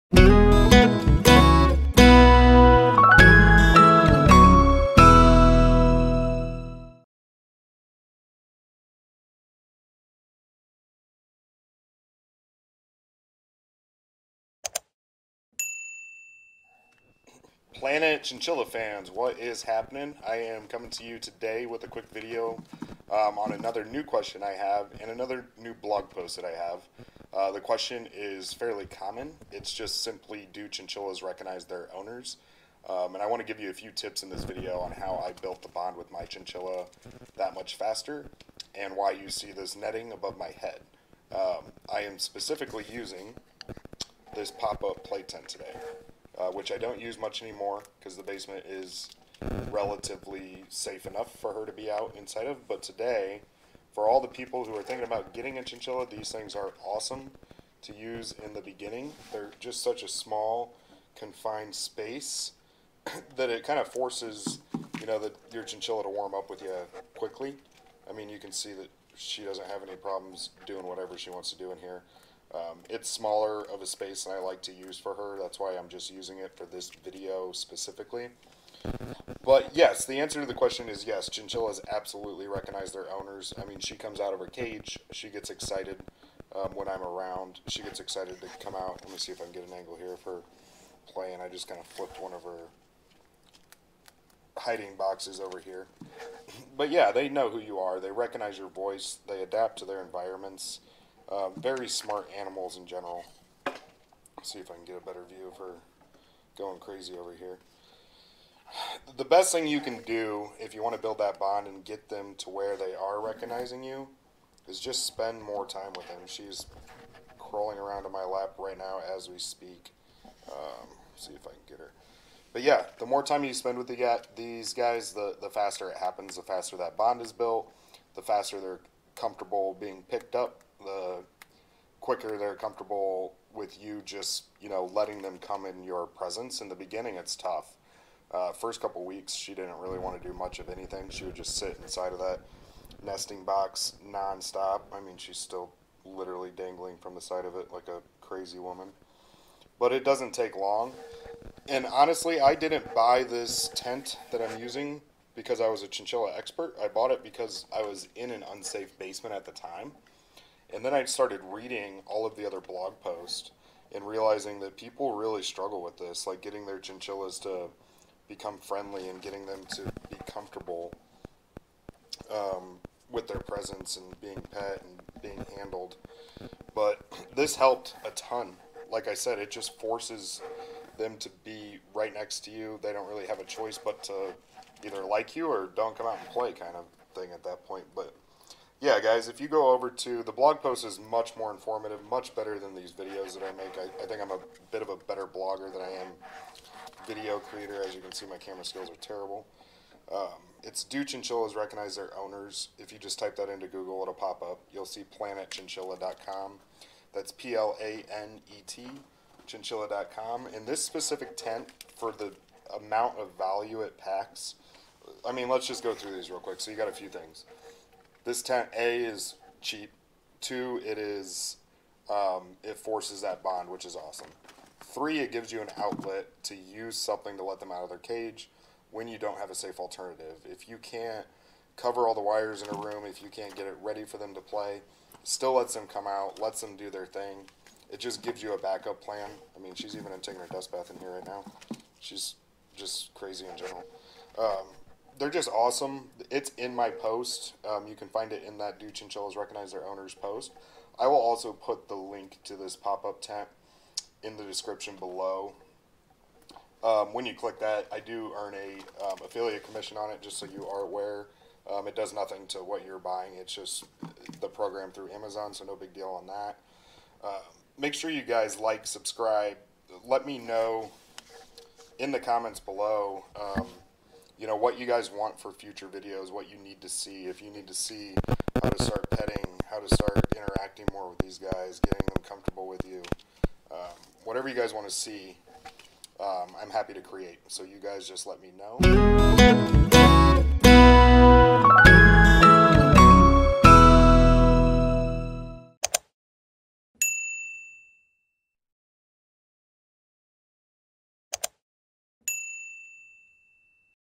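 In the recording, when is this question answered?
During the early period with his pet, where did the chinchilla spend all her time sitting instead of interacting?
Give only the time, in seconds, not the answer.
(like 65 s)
143 s.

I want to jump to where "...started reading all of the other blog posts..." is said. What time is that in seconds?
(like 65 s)
161 s.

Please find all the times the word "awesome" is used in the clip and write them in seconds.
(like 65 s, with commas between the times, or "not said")
56 s, 223 s, 245 s.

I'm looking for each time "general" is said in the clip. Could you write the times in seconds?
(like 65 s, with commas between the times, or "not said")
102 s, 243 s.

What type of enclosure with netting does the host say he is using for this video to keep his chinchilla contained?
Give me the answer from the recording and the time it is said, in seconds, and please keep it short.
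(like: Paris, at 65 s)
pop-up play tent, at 44 s.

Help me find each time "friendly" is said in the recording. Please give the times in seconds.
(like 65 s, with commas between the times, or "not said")
168 s.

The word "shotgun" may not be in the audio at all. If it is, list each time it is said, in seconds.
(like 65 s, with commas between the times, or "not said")
not said.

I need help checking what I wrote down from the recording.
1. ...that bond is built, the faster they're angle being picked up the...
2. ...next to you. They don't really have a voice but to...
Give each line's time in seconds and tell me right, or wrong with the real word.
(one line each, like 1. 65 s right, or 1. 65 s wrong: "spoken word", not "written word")
1. 126 s wrong: "comfortable", not "angle"
2. 182 s wrong: "choice", not "voice".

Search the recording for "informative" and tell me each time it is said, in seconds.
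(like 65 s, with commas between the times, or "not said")
191 s.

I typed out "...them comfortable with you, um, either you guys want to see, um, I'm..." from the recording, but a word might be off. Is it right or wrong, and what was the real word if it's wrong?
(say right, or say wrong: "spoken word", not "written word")
wrong: "whatever", not "either".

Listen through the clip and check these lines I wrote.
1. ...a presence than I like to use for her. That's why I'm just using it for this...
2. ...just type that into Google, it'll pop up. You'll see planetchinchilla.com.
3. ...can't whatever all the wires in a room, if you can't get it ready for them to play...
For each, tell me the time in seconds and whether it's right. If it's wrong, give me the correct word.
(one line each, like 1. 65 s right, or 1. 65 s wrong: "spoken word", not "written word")
1. 73 s wrong: "space", not "presence"
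2. 202 s right
3. 230 s wrong: "cover", not "whatever".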